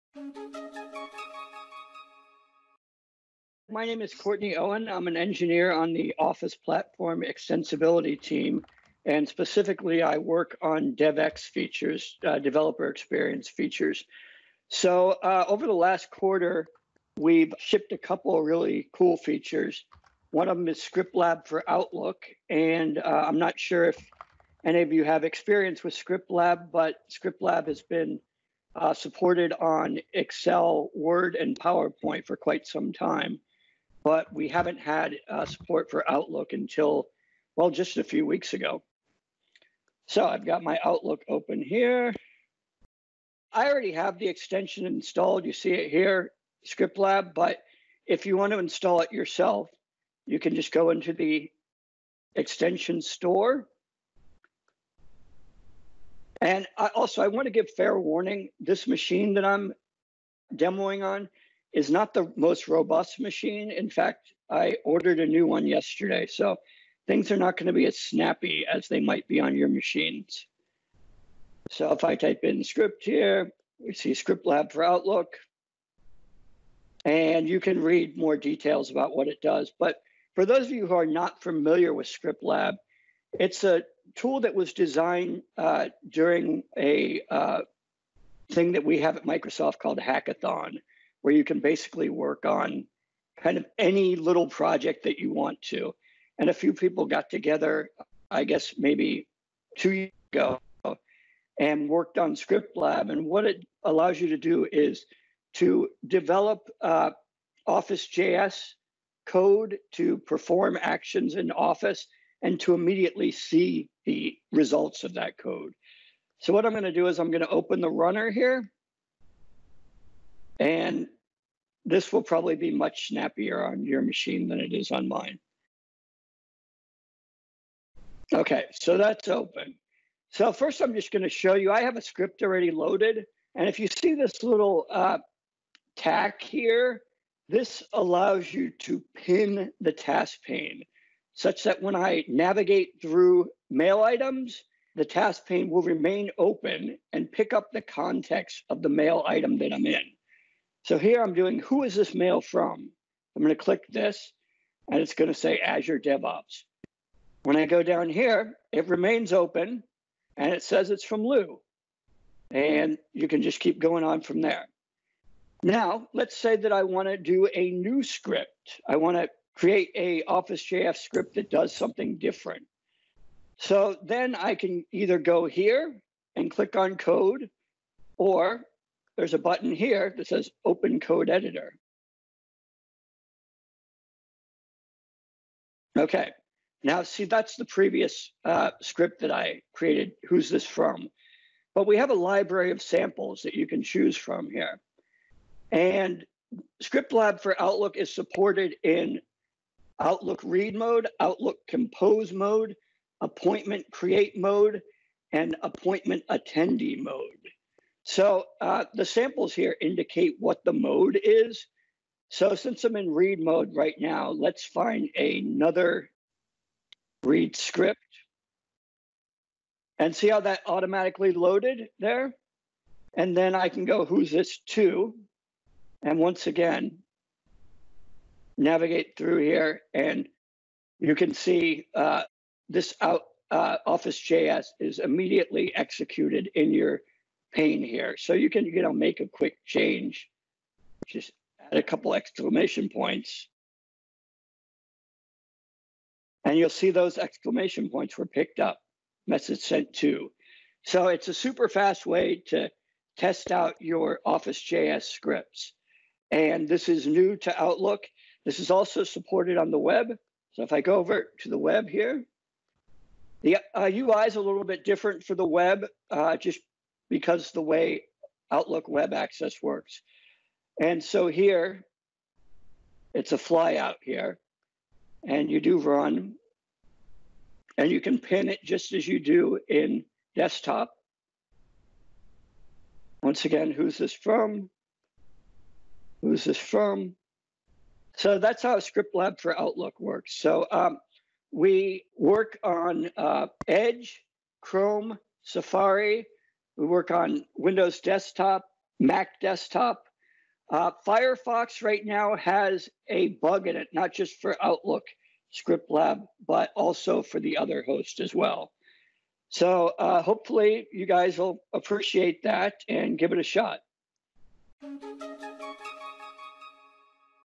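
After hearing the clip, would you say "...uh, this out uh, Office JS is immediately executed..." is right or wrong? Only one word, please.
right.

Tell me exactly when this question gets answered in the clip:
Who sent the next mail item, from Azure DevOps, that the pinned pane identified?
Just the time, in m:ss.
2:41.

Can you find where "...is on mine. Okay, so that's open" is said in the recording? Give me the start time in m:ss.
2:04.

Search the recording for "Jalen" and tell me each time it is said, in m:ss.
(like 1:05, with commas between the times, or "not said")
not said.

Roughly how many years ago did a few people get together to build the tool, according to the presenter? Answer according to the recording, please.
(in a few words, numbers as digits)
2.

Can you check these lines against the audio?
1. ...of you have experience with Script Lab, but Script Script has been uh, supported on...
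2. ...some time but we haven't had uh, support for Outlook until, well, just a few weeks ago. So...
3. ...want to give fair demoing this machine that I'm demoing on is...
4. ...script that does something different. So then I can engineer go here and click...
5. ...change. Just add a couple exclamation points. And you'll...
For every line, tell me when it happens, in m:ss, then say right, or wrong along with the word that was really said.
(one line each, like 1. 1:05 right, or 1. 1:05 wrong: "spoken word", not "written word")
1. 0:24 wrong: "Lab", not "Script"
2. 0:32 right
3. 0:57 wrong: "warning", not "demoing"
4. 2:50 wrong: "either", not "engineer"
5. 3:59 right.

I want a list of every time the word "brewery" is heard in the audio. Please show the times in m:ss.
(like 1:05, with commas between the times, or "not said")
not said.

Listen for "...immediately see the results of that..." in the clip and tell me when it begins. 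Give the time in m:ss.
1:52.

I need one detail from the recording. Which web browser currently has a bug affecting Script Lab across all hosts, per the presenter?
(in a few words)
Firefox.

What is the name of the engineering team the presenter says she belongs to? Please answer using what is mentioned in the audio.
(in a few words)
Office Platform Extensibility.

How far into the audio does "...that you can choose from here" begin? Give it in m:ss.
3:13.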